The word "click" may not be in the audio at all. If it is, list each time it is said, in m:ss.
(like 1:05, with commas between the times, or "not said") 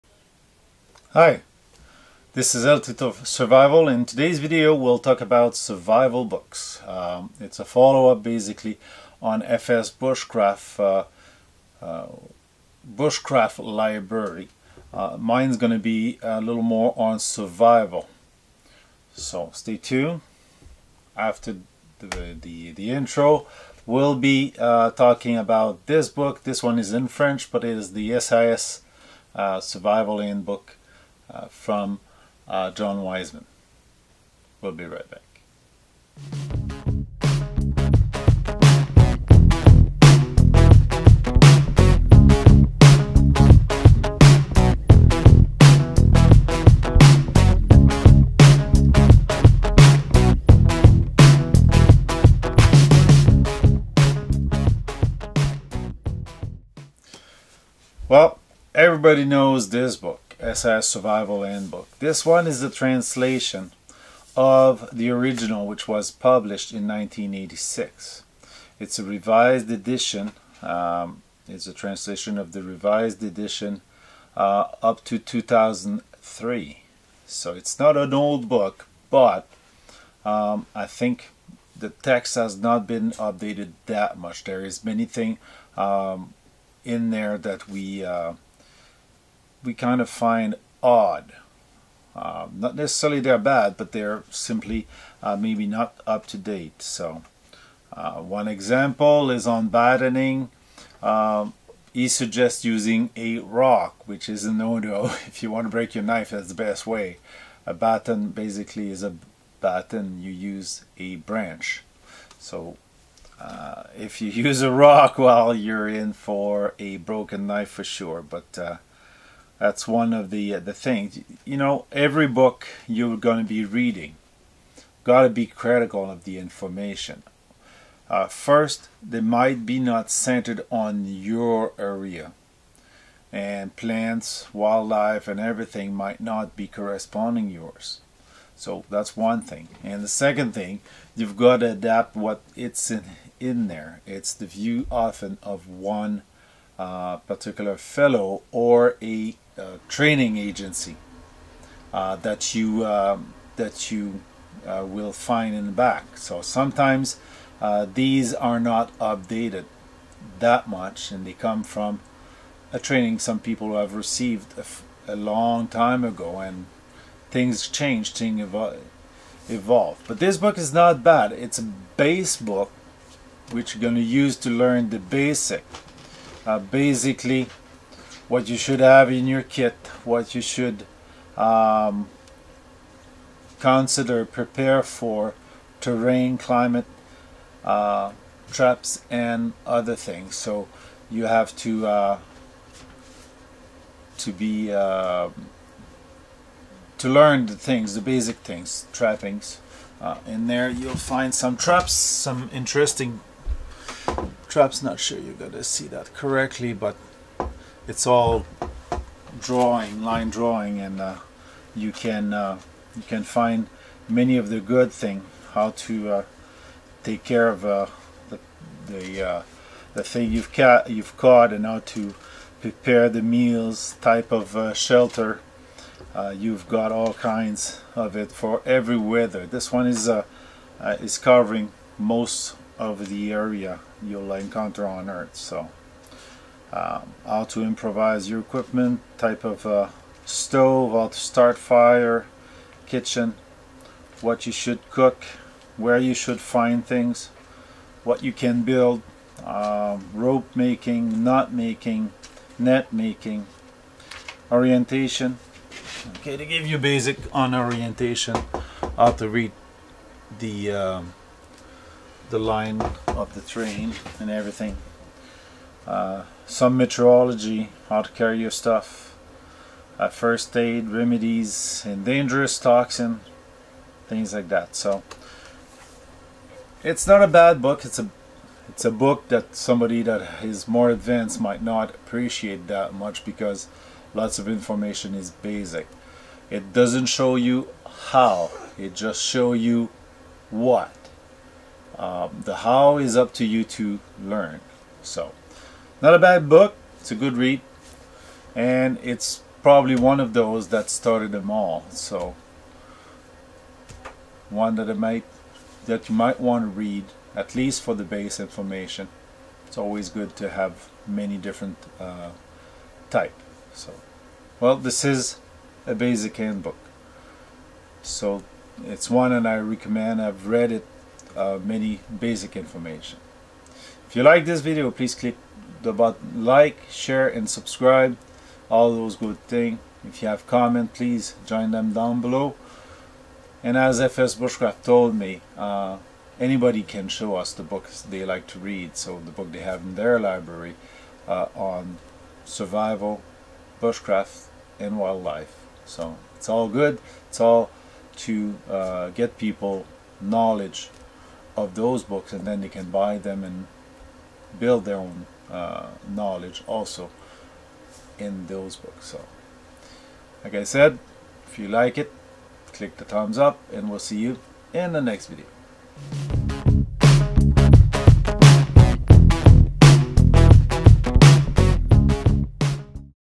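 5:25, 6:02.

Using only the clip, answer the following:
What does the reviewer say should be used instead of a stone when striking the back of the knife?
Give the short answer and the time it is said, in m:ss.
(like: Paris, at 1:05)
A branch, at 1:51.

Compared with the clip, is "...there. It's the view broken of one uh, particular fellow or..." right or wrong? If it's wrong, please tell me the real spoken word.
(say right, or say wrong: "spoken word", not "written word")
wrong: "often", not "broken".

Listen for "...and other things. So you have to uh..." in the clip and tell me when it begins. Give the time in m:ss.
3:09.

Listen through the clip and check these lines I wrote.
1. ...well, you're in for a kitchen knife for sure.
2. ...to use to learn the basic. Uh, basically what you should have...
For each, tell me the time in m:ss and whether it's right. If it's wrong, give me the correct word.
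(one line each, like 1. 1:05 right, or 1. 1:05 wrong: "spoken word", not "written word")
1. 1:55 wrong: "broken", not "kitchen"
2. 2:53 right.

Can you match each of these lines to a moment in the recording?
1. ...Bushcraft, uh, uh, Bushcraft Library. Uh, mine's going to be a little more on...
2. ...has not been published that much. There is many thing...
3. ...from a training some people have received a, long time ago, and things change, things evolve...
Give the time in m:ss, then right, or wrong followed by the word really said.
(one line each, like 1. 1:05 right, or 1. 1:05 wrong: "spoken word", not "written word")
1. 0:09 right
2. 1:22 wrong: "updated", not "published"
3. 2:41 right.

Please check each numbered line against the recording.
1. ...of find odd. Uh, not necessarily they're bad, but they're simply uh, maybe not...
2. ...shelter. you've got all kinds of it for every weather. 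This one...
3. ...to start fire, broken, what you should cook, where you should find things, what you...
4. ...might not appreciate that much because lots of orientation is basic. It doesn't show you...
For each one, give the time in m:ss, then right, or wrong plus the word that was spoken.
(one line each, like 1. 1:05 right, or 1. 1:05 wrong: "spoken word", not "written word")
1. 1:30 right
2. 3:44 right
3. 4:01 wrong: "kitchen", not "broken"
4. 4:41 wrong: "information", not "orientation".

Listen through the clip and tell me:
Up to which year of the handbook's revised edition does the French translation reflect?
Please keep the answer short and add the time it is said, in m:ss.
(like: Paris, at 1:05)
2003, at 1:15.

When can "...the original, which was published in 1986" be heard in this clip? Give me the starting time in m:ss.
1:04.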